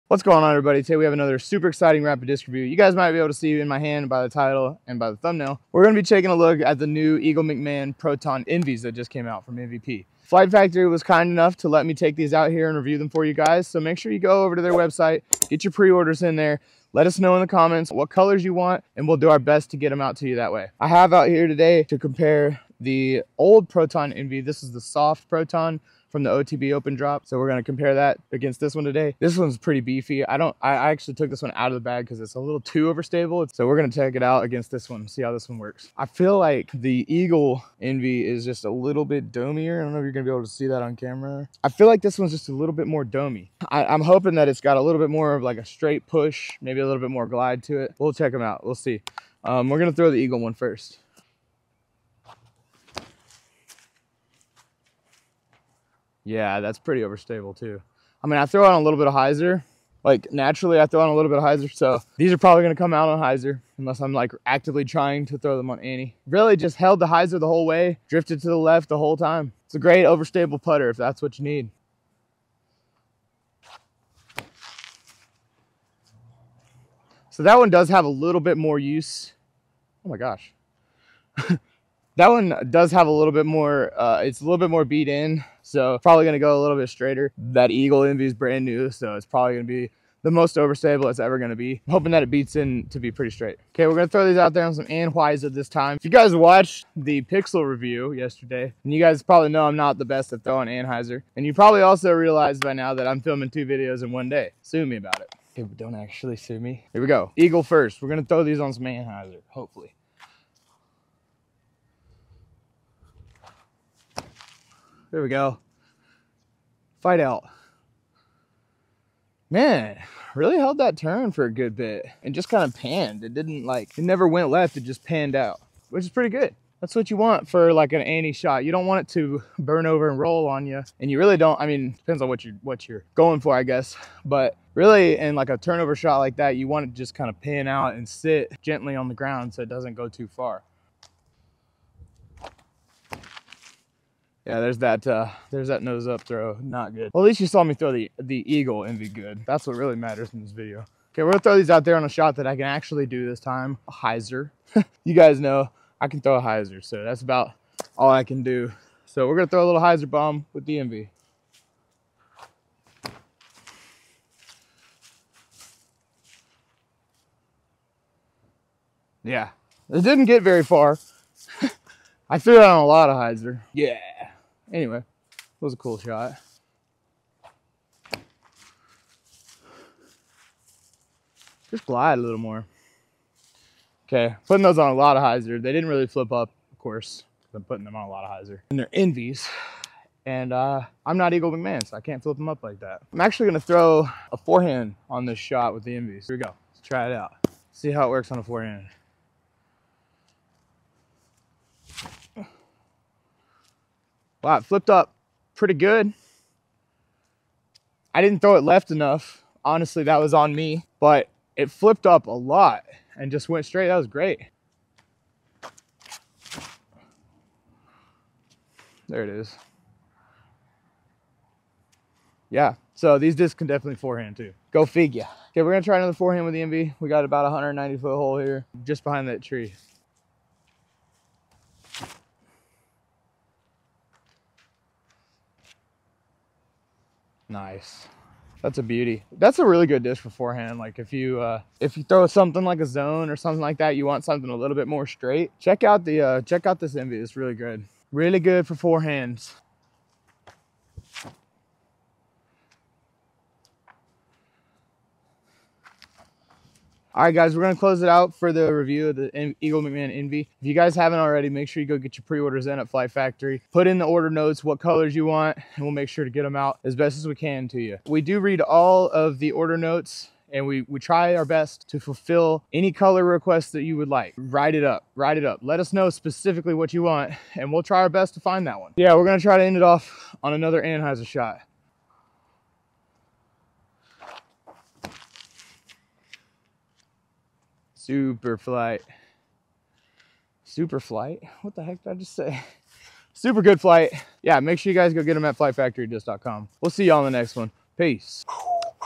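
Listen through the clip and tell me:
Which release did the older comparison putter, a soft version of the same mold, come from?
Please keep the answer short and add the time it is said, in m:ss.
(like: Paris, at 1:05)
OTB open drop, at 0:26.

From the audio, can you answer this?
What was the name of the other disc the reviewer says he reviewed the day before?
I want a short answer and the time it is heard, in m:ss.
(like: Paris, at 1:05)
Pixel, at 1:37.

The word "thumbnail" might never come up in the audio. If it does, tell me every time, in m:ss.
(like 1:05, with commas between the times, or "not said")
0:05.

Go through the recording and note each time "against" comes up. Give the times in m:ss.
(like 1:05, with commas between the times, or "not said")
0:28, 0:34.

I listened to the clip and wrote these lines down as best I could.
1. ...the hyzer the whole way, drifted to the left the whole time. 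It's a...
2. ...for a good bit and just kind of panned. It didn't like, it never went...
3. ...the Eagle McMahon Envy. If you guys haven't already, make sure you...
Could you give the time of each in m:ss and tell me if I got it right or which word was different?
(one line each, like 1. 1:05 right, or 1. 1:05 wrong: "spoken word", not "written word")
1. 1:06 right
2. 2:01 right
3. 4:19 right.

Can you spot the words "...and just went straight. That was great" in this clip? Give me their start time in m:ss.
3:33.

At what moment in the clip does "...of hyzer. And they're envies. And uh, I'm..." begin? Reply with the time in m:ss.
3:08.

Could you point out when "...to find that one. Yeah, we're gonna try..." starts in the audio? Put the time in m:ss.
4:38.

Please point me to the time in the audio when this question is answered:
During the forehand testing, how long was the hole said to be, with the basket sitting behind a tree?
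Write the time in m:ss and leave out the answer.
3:47.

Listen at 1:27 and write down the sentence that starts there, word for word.
That Eagle Envy is brand new, so it's probably gonna be the most overstable it's ever gonna be.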